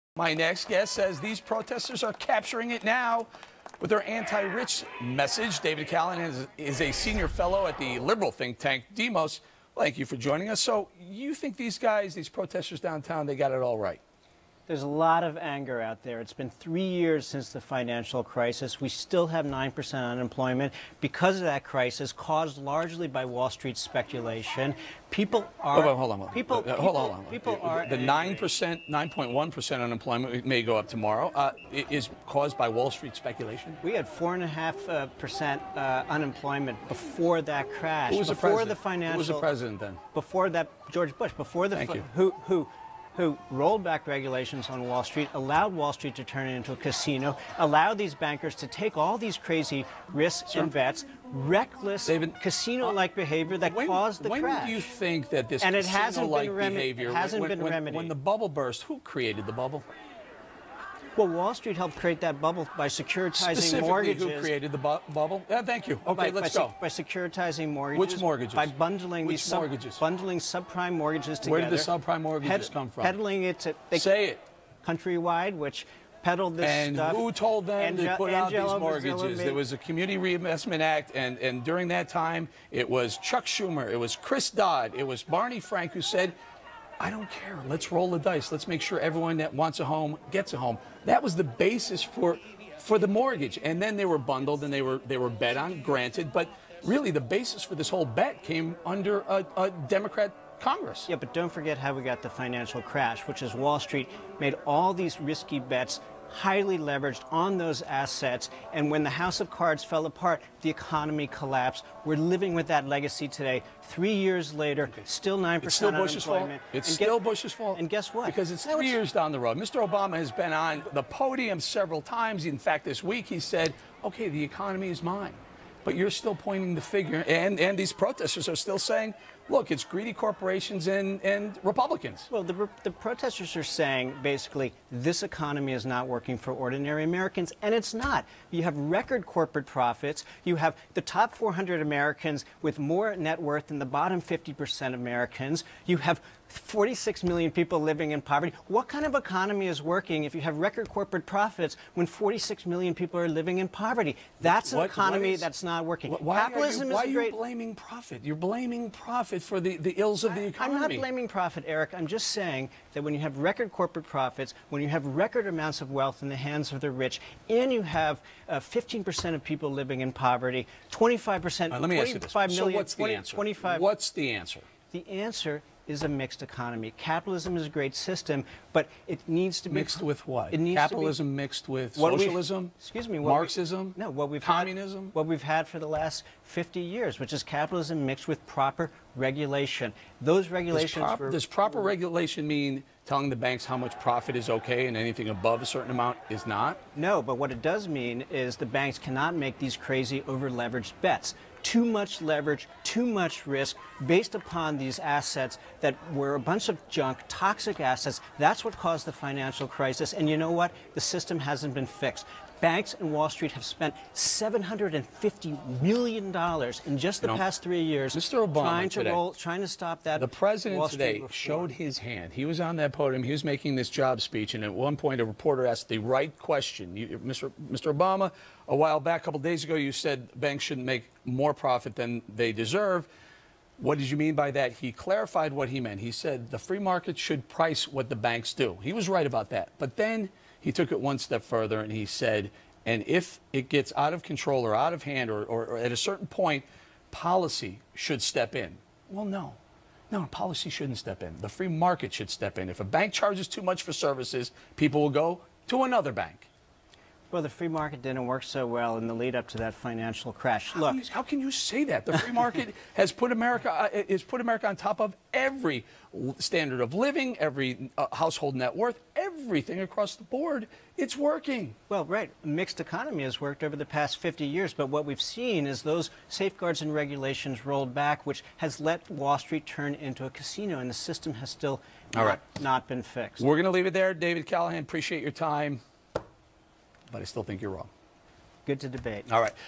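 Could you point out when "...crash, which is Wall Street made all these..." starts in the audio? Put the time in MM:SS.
01:42.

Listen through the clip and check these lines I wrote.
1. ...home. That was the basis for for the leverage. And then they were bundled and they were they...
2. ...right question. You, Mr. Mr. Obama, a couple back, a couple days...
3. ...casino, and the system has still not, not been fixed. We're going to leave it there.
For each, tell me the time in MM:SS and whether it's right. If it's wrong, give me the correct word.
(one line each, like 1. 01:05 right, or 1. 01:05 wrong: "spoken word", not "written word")
1. 01:30 wrong: "mortgage", not "leverage"
2. 03:45 wrong: "while", not "couple"
3. 04:40 right.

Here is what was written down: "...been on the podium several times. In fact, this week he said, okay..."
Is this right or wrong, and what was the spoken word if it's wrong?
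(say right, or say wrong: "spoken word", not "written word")
right.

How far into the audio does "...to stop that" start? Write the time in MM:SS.
03:39.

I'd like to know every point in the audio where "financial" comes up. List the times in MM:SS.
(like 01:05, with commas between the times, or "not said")
00:17, 00:38, 01:42, 03:29, 04:19.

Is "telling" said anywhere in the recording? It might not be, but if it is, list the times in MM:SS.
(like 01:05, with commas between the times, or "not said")
03:13.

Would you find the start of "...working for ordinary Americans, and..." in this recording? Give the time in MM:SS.
02:16.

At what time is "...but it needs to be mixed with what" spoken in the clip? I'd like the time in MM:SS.
02:58.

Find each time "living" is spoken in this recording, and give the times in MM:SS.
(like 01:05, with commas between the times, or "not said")
01:52, 02:27, 02:33, 02:49, 04:26.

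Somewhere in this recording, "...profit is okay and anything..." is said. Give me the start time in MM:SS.
03:13.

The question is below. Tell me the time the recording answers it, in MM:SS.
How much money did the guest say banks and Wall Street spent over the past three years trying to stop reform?
03:34.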